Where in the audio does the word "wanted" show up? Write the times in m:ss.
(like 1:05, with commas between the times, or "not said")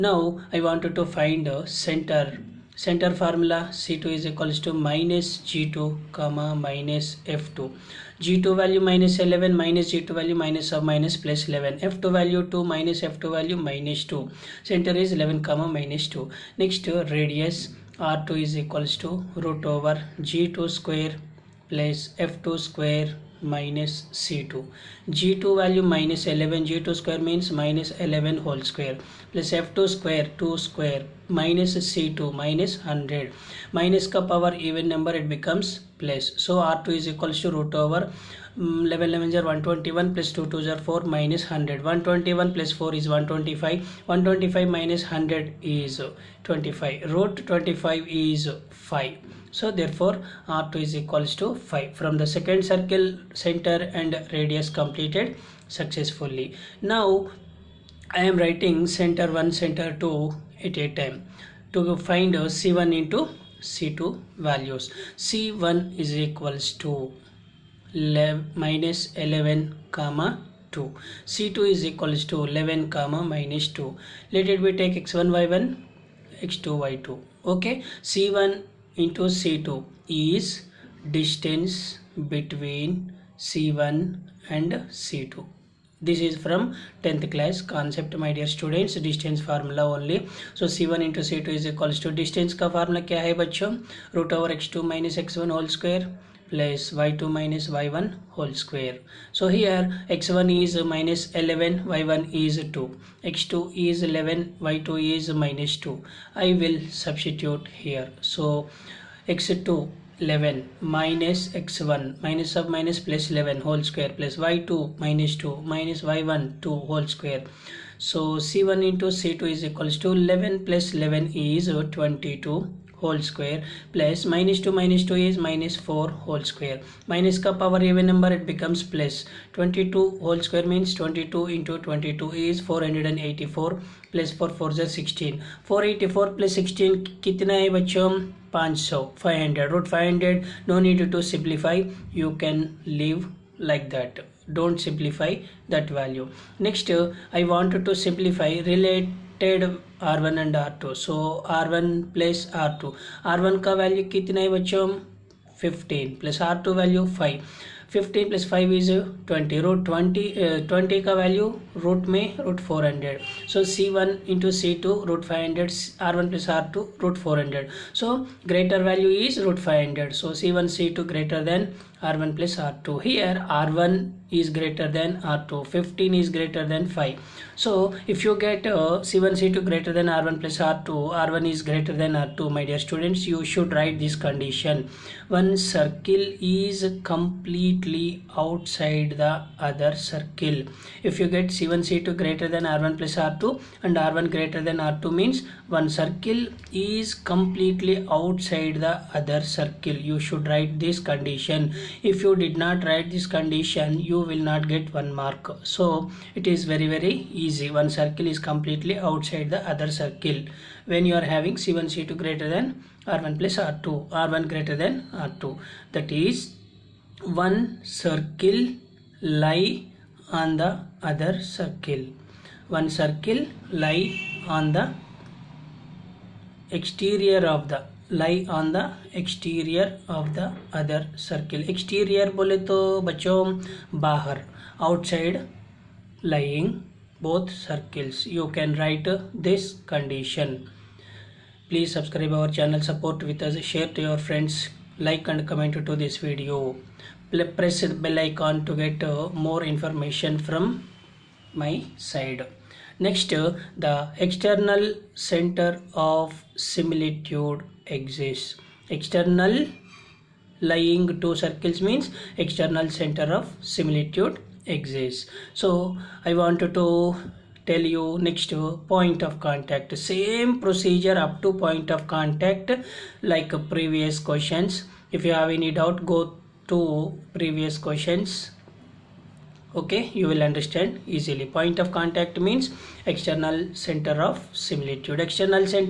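0:00, 2:27, 4:26.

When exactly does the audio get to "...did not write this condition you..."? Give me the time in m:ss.
3:22.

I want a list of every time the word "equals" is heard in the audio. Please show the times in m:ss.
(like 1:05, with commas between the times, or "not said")
0:04, 0:18, 0:37, 0:51, 1:06, 1:11, 1:31.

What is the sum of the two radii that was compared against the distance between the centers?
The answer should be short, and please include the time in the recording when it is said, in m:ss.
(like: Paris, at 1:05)
20, at 2:37.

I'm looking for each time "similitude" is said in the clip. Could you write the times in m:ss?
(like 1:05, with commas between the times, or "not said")
4:16, 4:23, 4:44.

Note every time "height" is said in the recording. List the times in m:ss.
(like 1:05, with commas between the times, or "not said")
not said.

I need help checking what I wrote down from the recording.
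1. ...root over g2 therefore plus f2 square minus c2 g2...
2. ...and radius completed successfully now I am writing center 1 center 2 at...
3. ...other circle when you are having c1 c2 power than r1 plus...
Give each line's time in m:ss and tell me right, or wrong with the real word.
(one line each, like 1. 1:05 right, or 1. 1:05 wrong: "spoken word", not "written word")
1. 0:19 wrong: "square", not "therefore"
2. 0:53 right
3. 3:29 wrong: "greater", not "power".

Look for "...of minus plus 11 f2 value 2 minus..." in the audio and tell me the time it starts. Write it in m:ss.
0:10.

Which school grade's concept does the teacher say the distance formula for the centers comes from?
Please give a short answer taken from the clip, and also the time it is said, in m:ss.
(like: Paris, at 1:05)
10th class, at 1:27.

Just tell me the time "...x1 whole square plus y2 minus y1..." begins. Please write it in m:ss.
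1:35.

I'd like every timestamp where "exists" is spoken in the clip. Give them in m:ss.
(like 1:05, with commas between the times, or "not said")
4:17, 4:24.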